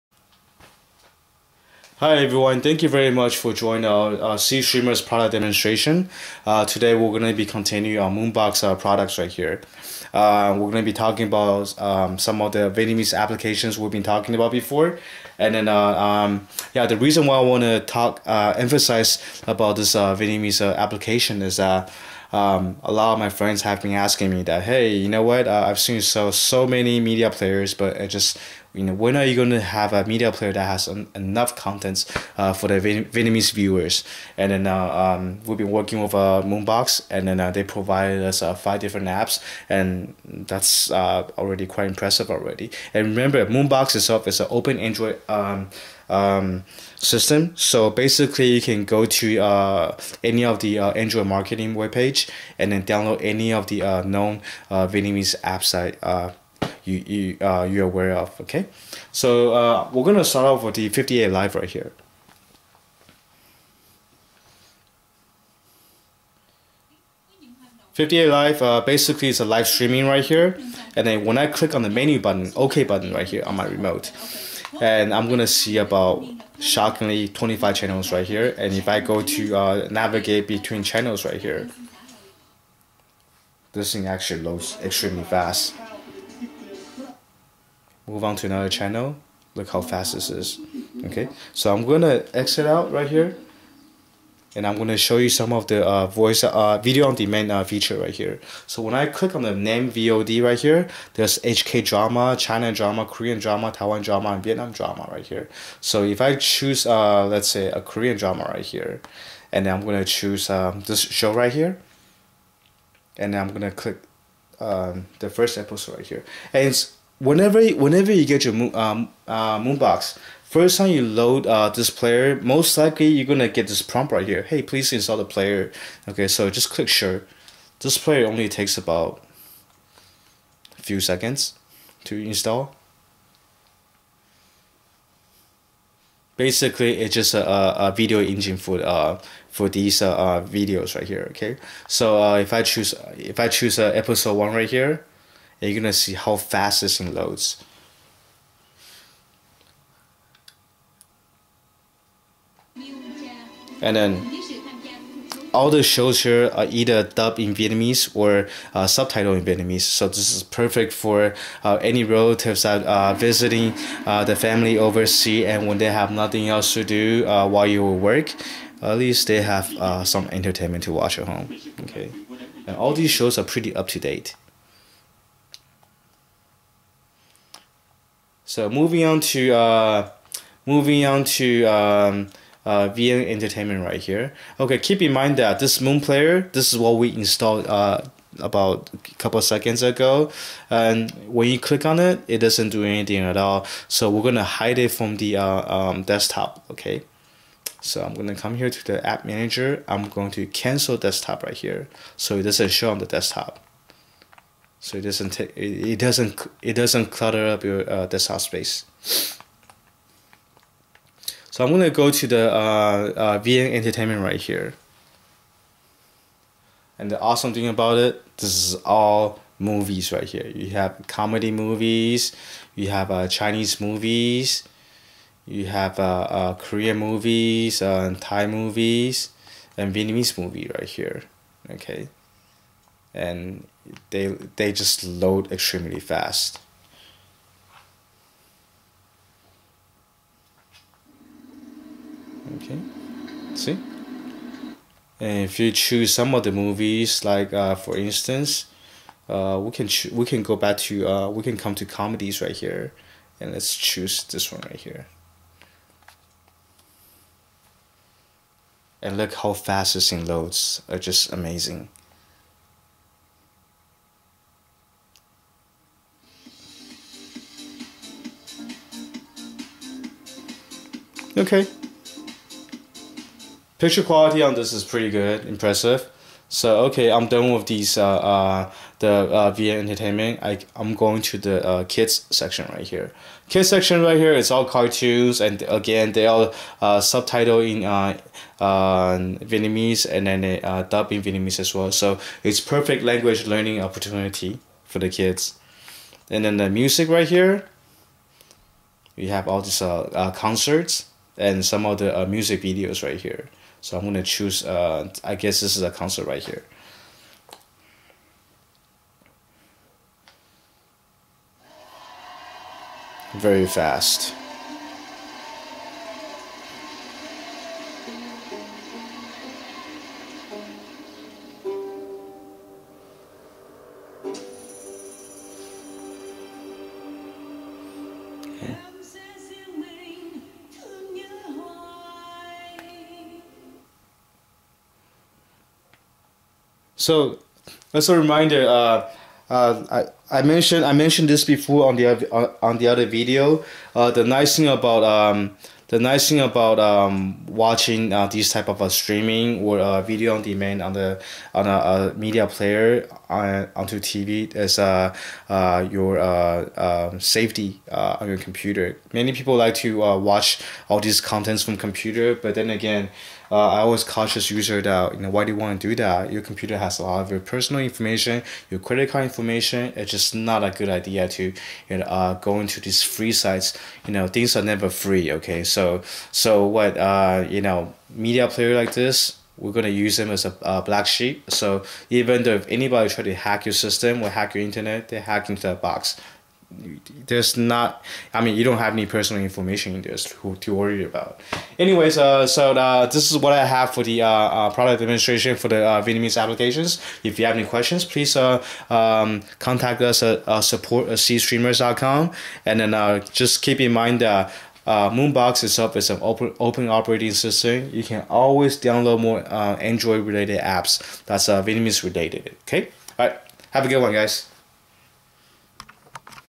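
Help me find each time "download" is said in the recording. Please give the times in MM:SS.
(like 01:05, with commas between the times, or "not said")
00:52, 06:48.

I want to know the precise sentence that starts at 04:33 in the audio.
Picture quality on this is pretty good, impressive.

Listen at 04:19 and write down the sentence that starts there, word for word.
And look how fast this thing loads are uh, just amazing.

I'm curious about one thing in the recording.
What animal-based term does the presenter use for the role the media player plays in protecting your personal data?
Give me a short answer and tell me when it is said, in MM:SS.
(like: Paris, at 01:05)
black sheep, at 06:20.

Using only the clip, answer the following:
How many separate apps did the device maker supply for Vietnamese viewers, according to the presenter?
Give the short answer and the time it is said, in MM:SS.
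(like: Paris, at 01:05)
5, at 00:38.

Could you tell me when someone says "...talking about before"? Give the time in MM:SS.
00:14.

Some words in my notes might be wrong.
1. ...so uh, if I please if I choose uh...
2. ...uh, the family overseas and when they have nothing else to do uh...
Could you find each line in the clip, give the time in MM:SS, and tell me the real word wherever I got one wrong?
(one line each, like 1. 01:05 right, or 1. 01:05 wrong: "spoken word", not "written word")
1. 02:21 wrong: "choose", not "please"
2. 02:44 right.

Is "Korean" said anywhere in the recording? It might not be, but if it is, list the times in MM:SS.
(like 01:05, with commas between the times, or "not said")
01:43, 01:47, 03:46.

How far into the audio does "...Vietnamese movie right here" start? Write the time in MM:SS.
03:49.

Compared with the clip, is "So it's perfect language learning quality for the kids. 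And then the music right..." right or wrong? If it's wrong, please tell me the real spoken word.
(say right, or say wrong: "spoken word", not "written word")
wrong: "opportunity", not "quality".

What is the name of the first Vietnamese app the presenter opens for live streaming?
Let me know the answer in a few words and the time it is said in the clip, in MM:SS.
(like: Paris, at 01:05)
58 Live, at 01:00.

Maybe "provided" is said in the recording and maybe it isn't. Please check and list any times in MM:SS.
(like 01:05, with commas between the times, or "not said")
00:37.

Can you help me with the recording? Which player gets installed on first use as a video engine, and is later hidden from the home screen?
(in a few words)
Moon Player.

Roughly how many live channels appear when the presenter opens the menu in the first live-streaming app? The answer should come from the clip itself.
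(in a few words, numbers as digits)
25.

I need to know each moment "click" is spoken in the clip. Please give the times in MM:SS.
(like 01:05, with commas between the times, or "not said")
01:11, 01:39, 01:53, 02:06, 03:11.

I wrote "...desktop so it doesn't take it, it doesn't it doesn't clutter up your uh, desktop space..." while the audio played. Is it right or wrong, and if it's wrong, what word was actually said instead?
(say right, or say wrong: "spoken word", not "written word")
right.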